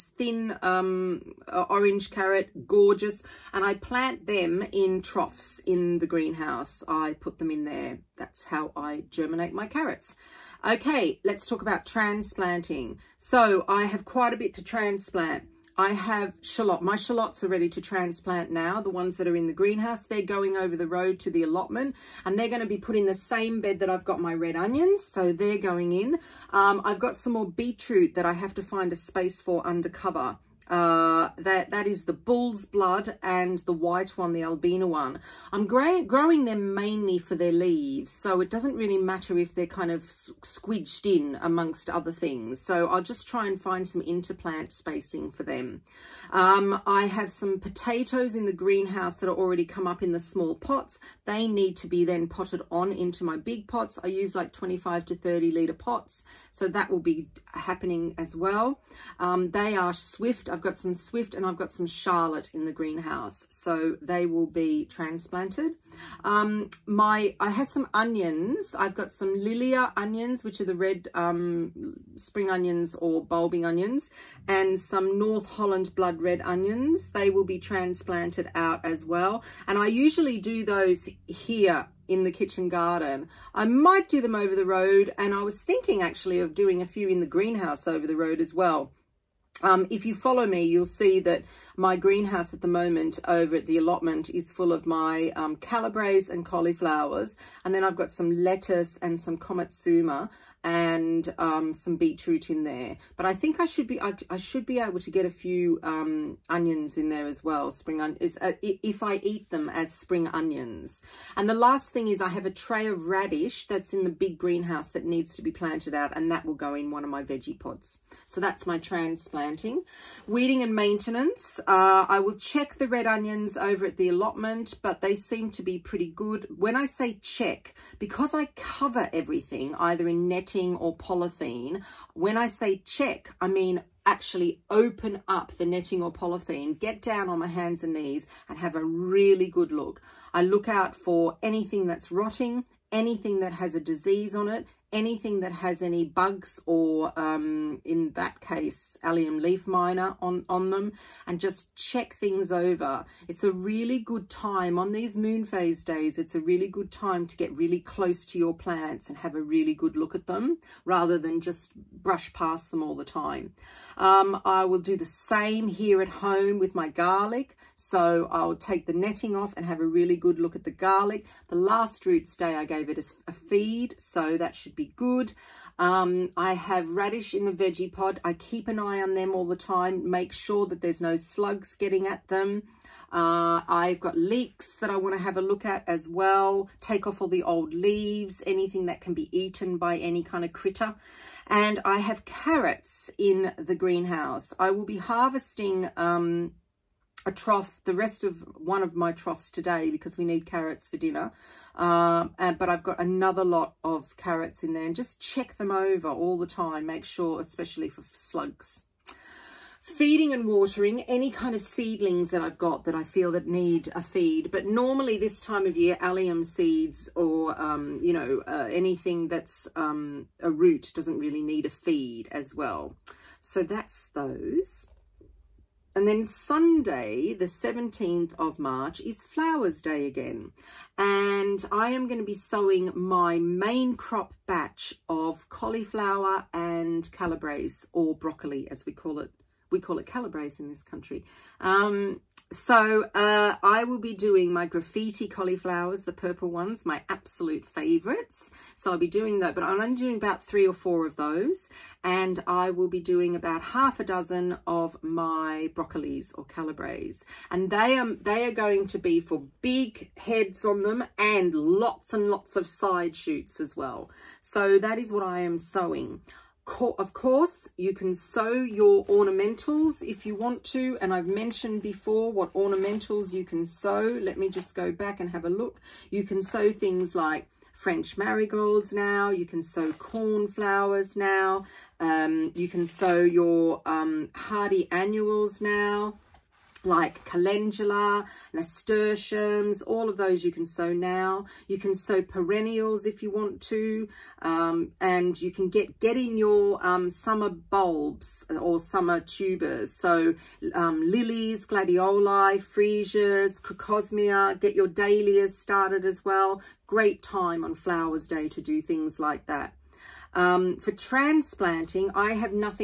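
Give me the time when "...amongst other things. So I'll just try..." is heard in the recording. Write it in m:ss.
0:41.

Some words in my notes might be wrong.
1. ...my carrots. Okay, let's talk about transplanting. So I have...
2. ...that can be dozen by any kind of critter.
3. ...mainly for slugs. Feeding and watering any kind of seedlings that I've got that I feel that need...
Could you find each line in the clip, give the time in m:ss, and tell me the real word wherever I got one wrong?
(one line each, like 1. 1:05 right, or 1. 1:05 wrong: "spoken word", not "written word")
1. 0:09 right
2. 3:08 wrong: "eaten", not "dozen"
3. 3:27 wrong: "especially", not "mainly".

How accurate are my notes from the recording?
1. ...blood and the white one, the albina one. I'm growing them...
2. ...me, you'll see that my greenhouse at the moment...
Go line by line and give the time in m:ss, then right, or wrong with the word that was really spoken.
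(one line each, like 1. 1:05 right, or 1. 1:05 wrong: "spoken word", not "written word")
1. 0:32 right
2. 1:30 right.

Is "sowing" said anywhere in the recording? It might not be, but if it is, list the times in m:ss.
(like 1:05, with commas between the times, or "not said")
3:52, 4:25.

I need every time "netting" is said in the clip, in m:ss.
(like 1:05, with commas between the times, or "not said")
2:10, 2:15, 2:48.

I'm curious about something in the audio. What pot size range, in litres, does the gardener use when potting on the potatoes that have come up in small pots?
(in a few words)
25 to 30 litres.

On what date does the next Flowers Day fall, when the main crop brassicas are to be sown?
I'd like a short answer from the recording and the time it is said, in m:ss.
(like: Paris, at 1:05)
Sunday 17 March, at 3:46.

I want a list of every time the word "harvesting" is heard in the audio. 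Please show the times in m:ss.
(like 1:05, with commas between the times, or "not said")
3:14.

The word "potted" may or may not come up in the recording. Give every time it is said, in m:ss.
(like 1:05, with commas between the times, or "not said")
0:52.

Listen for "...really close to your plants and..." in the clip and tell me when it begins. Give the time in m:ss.
2:37.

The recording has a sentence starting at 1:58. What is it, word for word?
So that's my transplanting, weeding and maintenance.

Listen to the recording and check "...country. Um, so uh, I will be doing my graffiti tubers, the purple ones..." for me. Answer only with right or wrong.
wrong.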